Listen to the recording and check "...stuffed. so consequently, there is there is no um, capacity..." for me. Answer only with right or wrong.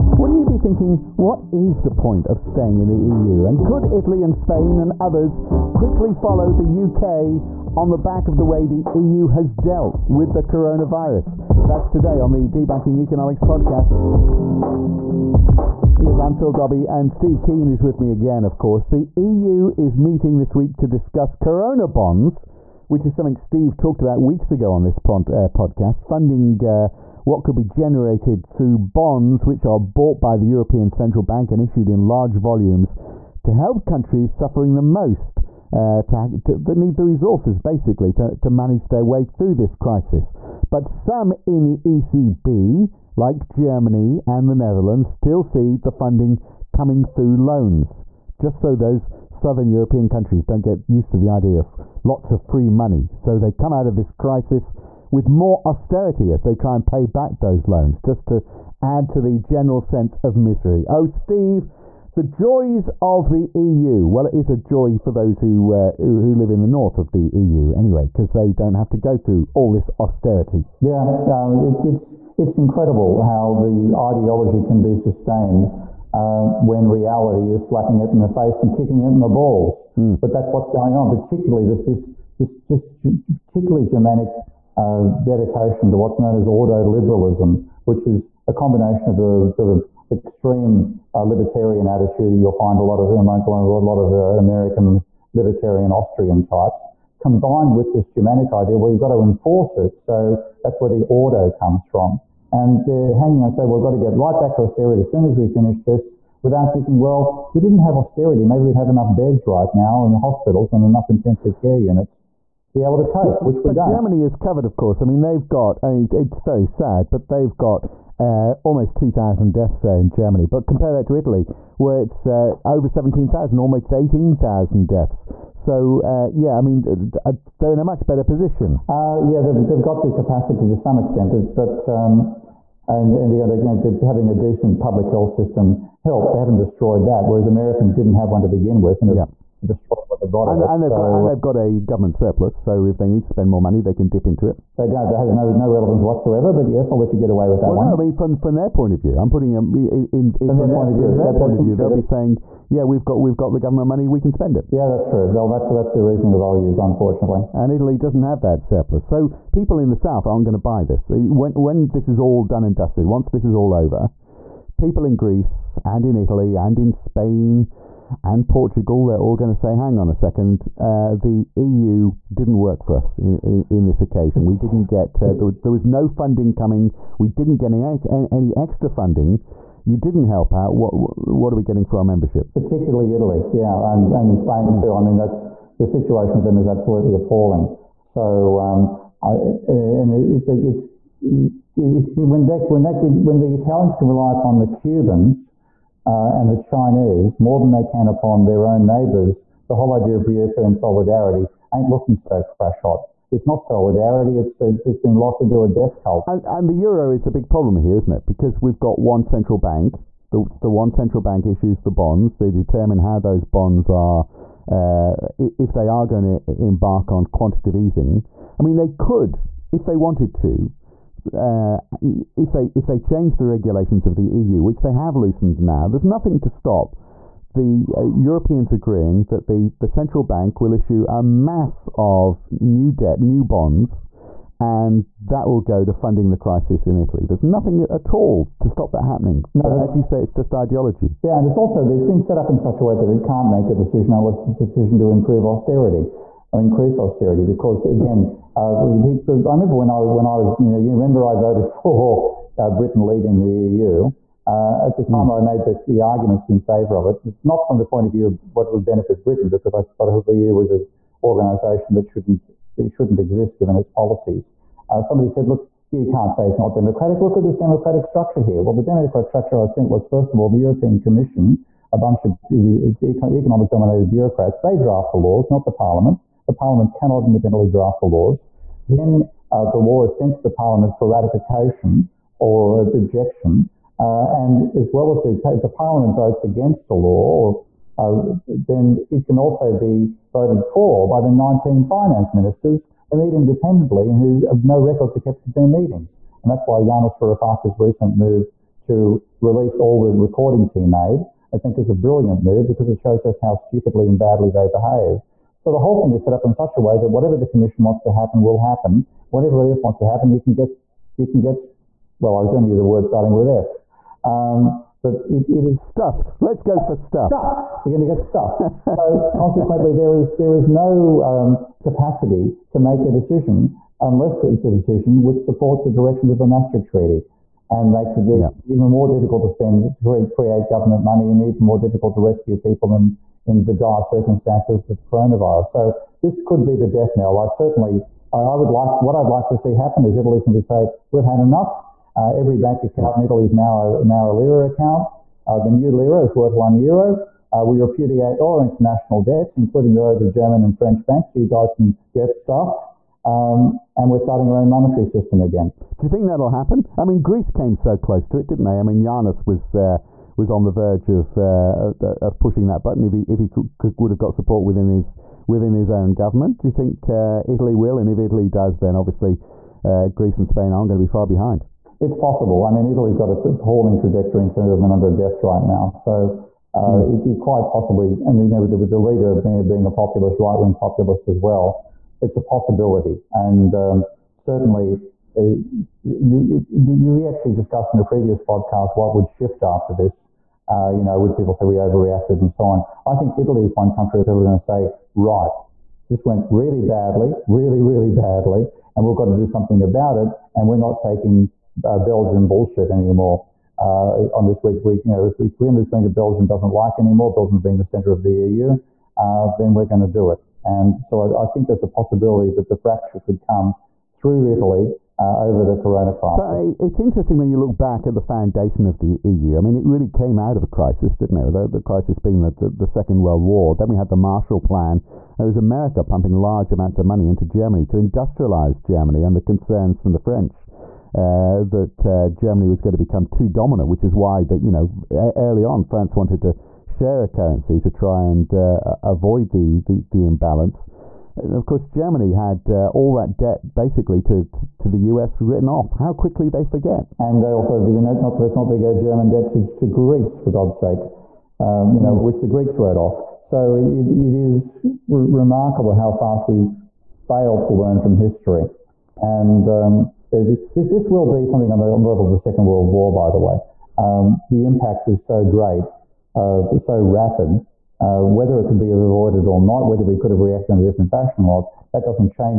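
right.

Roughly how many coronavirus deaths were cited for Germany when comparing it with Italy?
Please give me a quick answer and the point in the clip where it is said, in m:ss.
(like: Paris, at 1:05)
almost 2,000, at 1:58.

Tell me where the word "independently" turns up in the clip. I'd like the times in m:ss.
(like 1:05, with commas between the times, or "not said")
4:37, 4:53.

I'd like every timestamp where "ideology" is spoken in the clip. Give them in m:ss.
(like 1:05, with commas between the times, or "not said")
1:13, 4:00.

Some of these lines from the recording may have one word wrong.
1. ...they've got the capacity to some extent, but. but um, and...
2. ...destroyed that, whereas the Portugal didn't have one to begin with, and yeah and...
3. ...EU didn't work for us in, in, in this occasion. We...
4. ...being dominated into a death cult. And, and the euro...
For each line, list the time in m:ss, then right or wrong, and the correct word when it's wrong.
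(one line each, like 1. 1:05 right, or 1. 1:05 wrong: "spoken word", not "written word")
1. 2:09 right
2. 2:16 wrong: "Americans", not "Portugal"
3. 2:51 right
4. 3:24 wrong: "locked", not "dominated".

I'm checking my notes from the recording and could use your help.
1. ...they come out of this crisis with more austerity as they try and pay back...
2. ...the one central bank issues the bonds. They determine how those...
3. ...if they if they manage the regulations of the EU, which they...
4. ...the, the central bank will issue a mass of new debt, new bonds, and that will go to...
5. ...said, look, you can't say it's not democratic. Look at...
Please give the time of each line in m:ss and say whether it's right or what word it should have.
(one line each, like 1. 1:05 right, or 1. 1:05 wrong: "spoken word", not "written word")
1. 0:53 right
2. 3:30 right
3. 3:42 wrong: "change", not "manage"
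4. 3:49 right
5. 4:25 right.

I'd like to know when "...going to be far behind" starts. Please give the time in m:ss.
6:10.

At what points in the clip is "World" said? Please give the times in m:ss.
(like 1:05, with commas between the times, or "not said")
7:03, 7:42.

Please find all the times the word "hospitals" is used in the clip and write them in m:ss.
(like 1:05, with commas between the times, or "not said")
1:50.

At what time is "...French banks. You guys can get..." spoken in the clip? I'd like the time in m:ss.
5:50.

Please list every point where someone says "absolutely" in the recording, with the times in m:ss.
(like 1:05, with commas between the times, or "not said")
3:06.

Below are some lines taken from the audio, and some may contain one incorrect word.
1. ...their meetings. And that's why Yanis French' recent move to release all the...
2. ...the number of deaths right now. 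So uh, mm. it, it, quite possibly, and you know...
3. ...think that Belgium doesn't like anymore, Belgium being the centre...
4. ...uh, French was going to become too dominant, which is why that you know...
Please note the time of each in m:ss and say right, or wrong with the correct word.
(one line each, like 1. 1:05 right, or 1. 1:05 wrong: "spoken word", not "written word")
1. 4:55 wrong: "Varoufakis", not "French"
2. 6:14 right
3. 6:45 right
4. 7:12 wrong: "Germany", not "French".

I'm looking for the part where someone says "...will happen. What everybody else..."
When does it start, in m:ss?
5:08.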